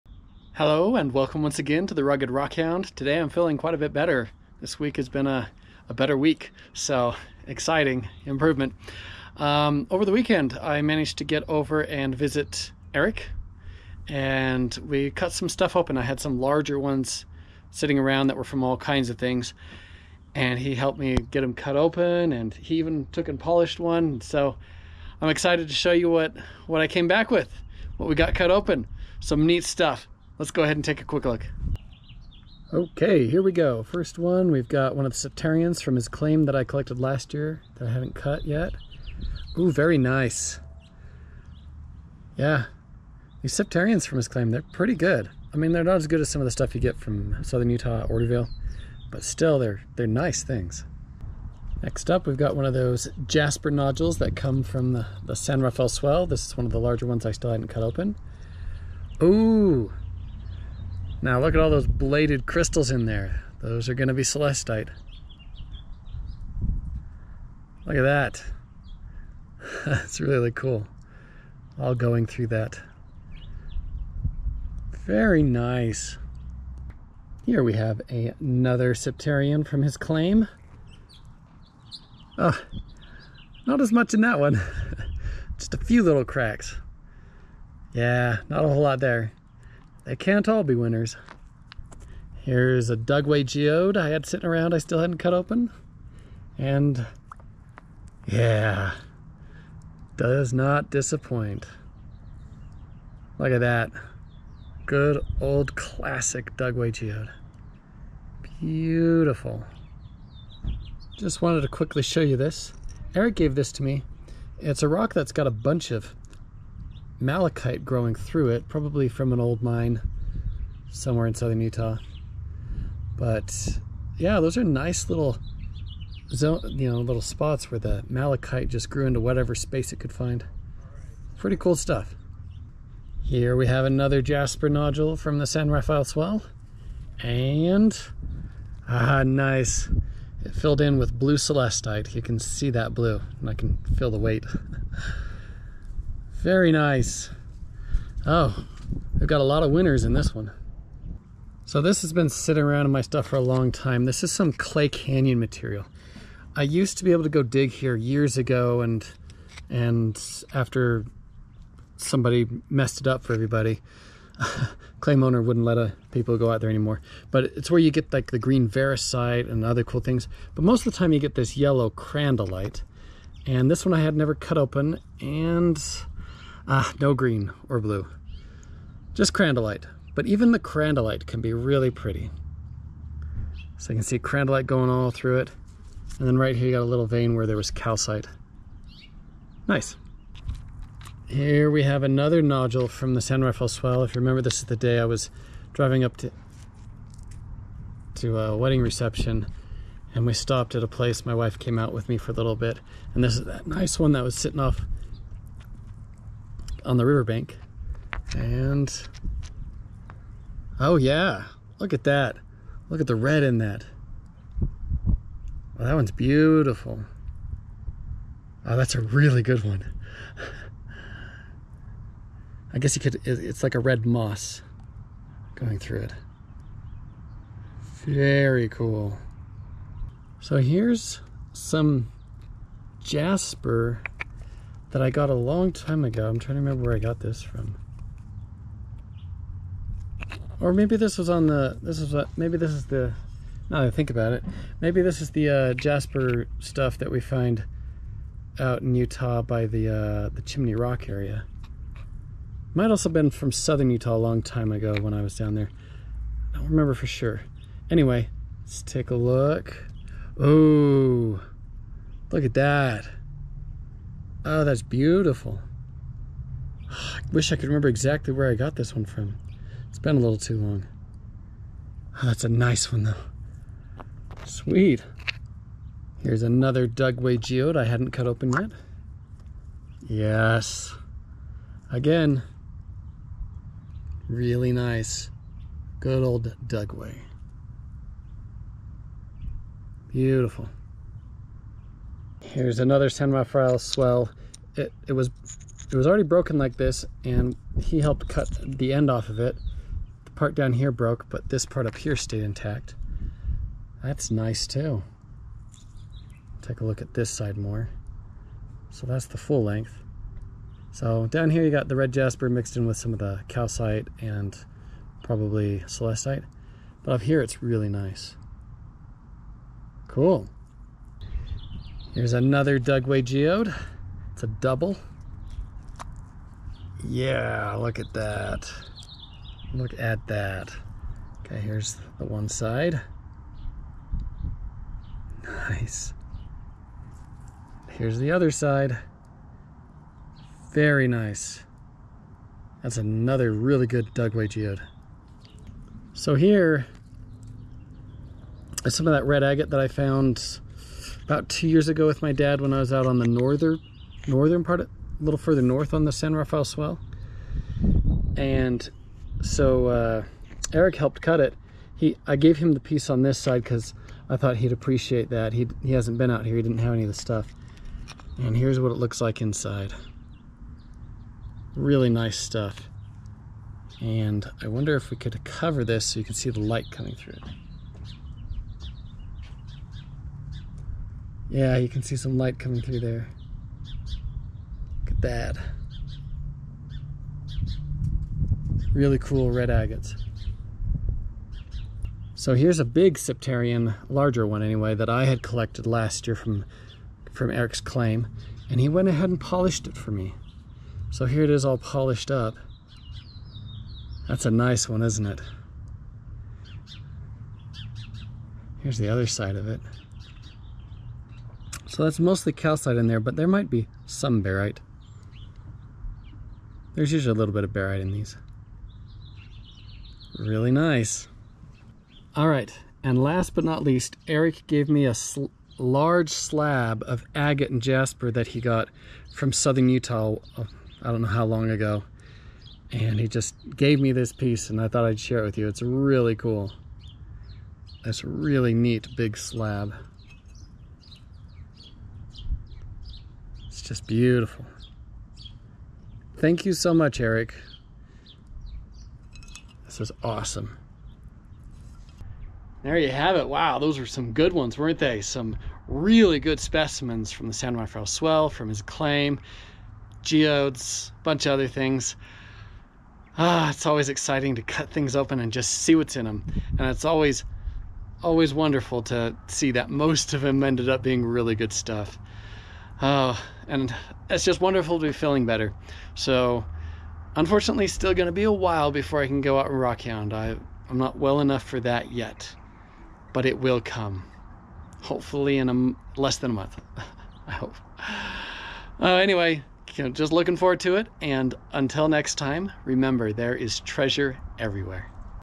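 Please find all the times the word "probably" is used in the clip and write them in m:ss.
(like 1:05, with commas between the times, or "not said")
1:58, 5:15.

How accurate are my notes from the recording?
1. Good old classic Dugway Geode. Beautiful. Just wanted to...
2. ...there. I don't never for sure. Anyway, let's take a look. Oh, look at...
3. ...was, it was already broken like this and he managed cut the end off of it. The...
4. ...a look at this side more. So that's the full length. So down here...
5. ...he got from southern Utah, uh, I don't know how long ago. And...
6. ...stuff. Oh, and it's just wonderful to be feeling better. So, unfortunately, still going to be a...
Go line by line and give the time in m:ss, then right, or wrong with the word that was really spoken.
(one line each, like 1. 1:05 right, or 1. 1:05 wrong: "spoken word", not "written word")
1. 1:44 right
2. 4:15 wrong: "remember", not "never"
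3. 4:55 wrong: "helped", not "managed"
4. 5:06 right
5. 7:08 right
6. 7:51 right.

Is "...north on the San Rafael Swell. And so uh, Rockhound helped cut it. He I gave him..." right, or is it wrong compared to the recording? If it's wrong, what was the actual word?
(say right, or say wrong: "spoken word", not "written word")
wrong: "Eric", not "Rockhound".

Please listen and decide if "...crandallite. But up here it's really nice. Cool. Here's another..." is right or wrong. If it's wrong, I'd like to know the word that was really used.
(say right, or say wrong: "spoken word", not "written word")
wrong: "celestite", not "crandallite".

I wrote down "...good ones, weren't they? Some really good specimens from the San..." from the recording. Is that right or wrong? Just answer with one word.
right.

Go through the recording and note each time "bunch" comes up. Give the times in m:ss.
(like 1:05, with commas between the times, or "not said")
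1:55, 7:41.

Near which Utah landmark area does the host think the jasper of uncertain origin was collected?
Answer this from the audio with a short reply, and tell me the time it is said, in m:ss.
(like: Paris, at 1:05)
Chimney Rock, at 4:10.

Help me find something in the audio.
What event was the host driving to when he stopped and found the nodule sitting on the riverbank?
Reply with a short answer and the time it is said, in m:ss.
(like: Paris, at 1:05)
a wedding reception, at 3:18.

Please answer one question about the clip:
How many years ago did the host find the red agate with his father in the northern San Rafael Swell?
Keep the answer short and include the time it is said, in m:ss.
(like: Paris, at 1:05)
2, at 5:51.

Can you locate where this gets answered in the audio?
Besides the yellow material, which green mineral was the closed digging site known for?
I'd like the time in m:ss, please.
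2:48.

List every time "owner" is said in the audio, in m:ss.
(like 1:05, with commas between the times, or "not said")
2:45.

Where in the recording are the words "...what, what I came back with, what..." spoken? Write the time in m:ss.
0:26.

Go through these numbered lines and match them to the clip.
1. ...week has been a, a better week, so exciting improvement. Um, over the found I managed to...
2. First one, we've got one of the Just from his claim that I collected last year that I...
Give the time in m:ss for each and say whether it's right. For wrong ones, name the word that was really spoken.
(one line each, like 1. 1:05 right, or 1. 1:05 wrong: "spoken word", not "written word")
1. 0:04 wrong: "weekend", not "found"
2. 0:33 wrong: "Septarians", not "Just".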